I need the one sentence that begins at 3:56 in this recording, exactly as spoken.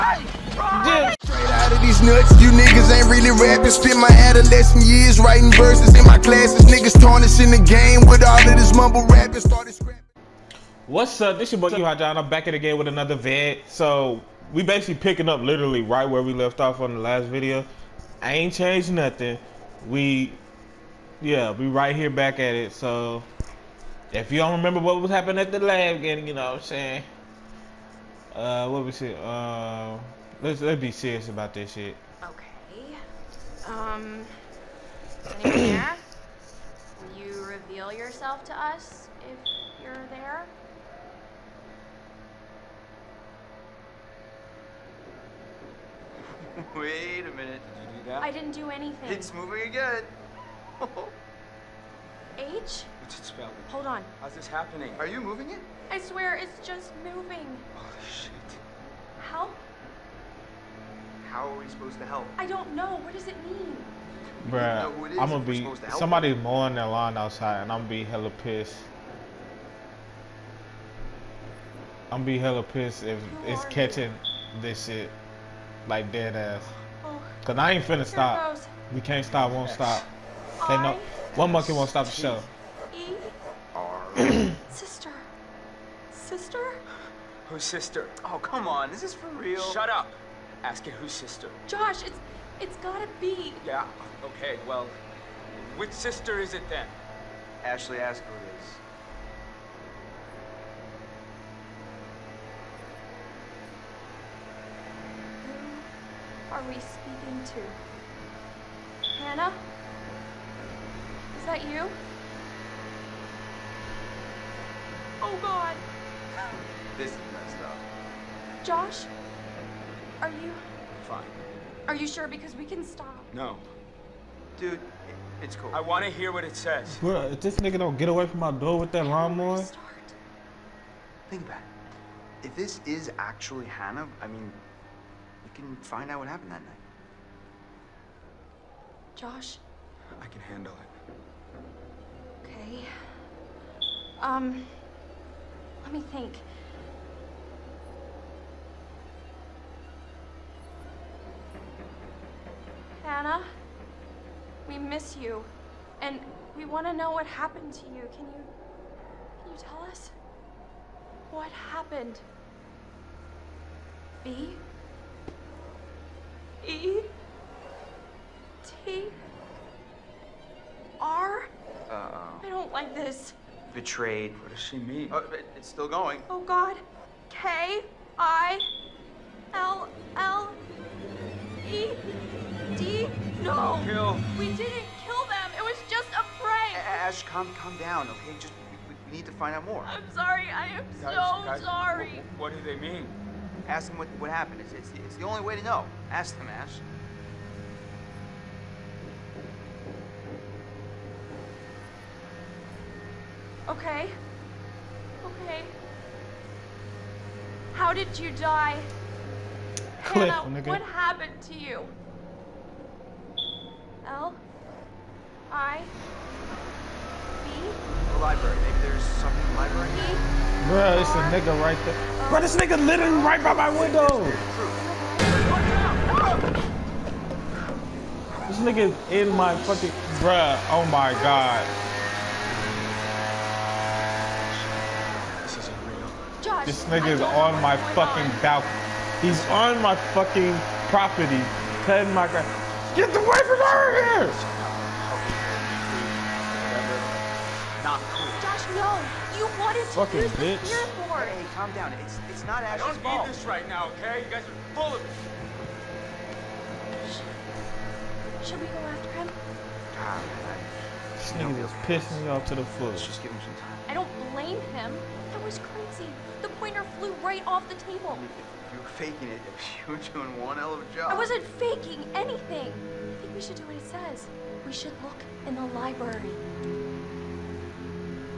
This nigga is on my fucking balcony.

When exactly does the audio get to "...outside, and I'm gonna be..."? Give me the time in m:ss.
1:07.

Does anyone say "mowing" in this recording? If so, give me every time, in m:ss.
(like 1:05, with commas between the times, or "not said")
1:06.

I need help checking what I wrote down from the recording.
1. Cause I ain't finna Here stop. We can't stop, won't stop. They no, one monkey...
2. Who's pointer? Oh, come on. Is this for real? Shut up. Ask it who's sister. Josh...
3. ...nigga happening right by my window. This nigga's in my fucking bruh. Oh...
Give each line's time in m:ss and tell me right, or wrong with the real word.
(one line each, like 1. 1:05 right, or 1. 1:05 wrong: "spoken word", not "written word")
1. 1:17 right
2. 1:27 wrong: "sister", not "pointer"
3. 3:42 wrong: "living", not "happening".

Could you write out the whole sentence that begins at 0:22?
So if you don't remember what was happening at the lab, and you know what I'm saying, uh, what we say?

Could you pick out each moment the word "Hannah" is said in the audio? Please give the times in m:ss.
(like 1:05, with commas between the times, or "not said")
1:49, 2:13, 2:33, 3:30.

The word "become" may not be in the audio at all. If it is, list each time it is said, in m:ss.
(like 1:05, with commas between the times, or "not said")
not said.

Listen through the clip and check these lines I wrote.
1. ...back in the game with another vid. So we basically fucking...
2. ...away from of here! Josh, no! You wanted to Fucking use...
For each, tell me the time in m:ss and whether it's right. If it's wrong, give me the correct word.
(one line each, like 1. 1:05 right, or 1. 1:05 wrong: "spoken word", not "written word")
1. 0:12 wrong: "picking", not "fucking"
2. 4:03 right.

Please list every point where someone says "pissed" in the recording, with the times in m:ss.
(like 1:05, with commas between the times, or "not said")
1:08, 1:12, 4:21.